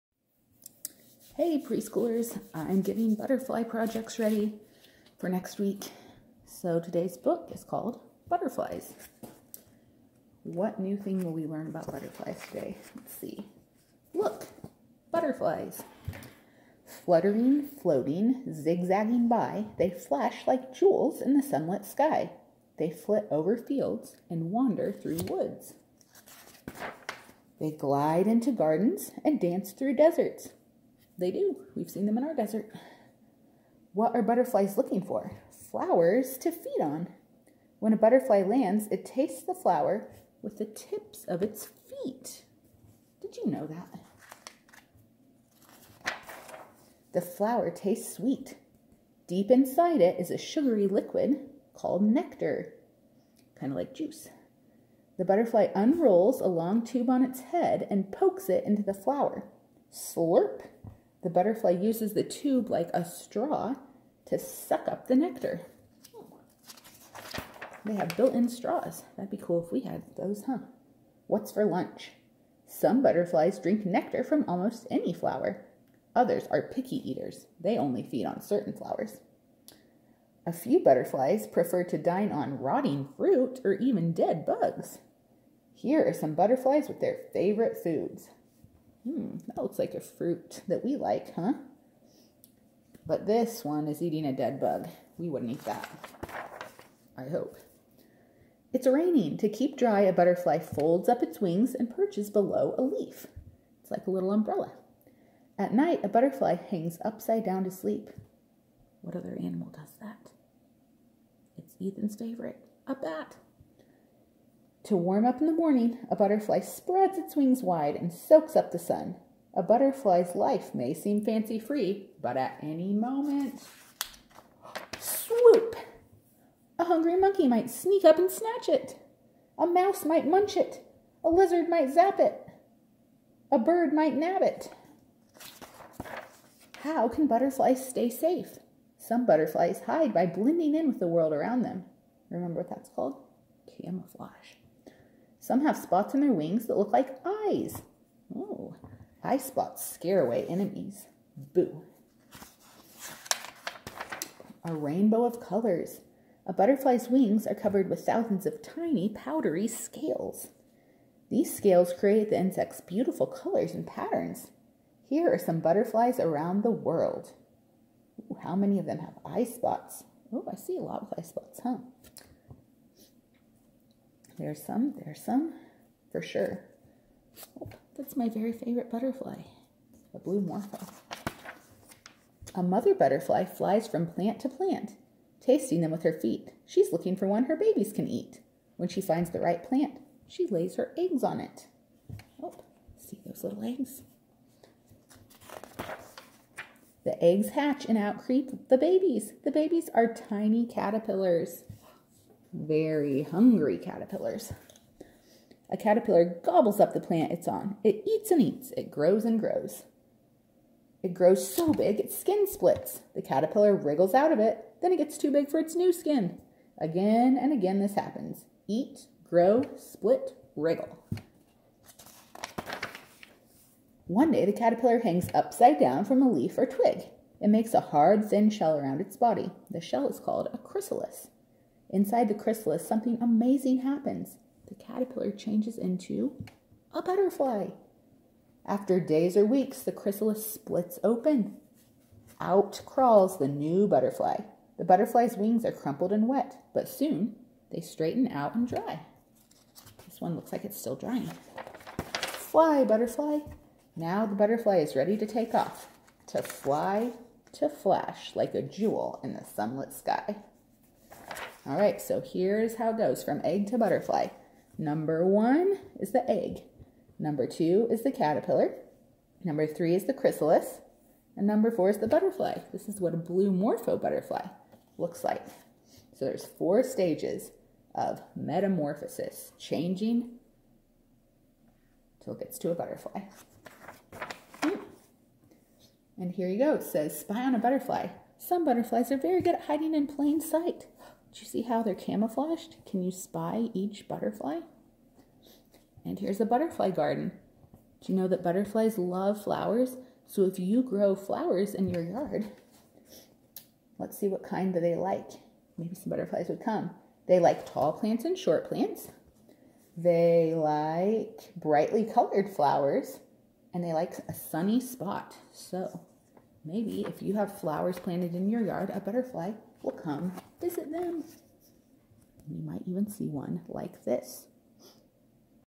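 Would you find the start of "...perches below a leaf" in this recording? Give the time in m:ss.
1:41.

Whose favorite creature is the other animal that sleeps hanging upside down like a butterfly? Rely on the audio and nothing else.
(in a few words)
Ethan.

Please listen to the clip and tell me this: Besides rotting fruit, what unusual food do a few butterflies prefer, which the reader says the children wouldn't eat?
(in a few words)
Dead bugs.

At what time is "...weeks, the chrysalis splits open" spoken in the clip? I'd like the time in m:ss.
3:59.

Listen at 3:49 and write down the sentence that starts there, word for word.
The shell is called a chrysalis.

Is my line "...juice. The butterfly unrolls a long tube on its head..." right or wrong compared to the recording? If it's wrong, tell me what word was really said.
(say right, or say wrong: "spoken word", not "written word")
right.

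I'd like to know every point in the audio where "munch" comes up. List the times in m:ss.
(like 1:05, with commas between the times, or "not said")
2:10.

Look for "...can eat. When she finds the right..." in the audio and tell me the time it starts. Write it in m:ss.
3:07.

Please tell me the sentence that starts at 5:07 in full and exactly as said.
They like tall plants and short plants.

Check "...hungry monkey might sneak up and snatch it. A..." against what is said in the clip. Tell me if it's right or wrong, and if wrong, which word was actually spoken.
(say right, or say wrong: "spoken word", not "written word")
right.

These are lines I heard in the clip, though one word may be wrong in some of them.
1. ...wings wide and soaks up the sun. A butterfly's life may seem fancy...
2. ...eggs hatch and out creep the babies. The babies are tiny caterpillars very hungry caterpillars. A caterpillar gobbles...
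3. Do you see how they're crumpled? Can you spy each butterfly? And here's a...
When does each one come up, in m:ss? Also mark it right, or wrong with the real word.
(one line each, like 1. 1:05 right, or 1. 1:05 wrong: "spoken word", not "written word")
1. 1:57 right
2. 3:17 right
3. 4:51 wrong: "camouflaged", not "crumpled".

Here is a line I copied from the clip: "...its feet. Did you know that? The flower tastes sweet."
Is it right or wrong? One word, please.
right.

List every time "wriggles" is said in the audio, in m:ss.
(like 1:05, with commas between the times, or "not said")
3:33, 3:40.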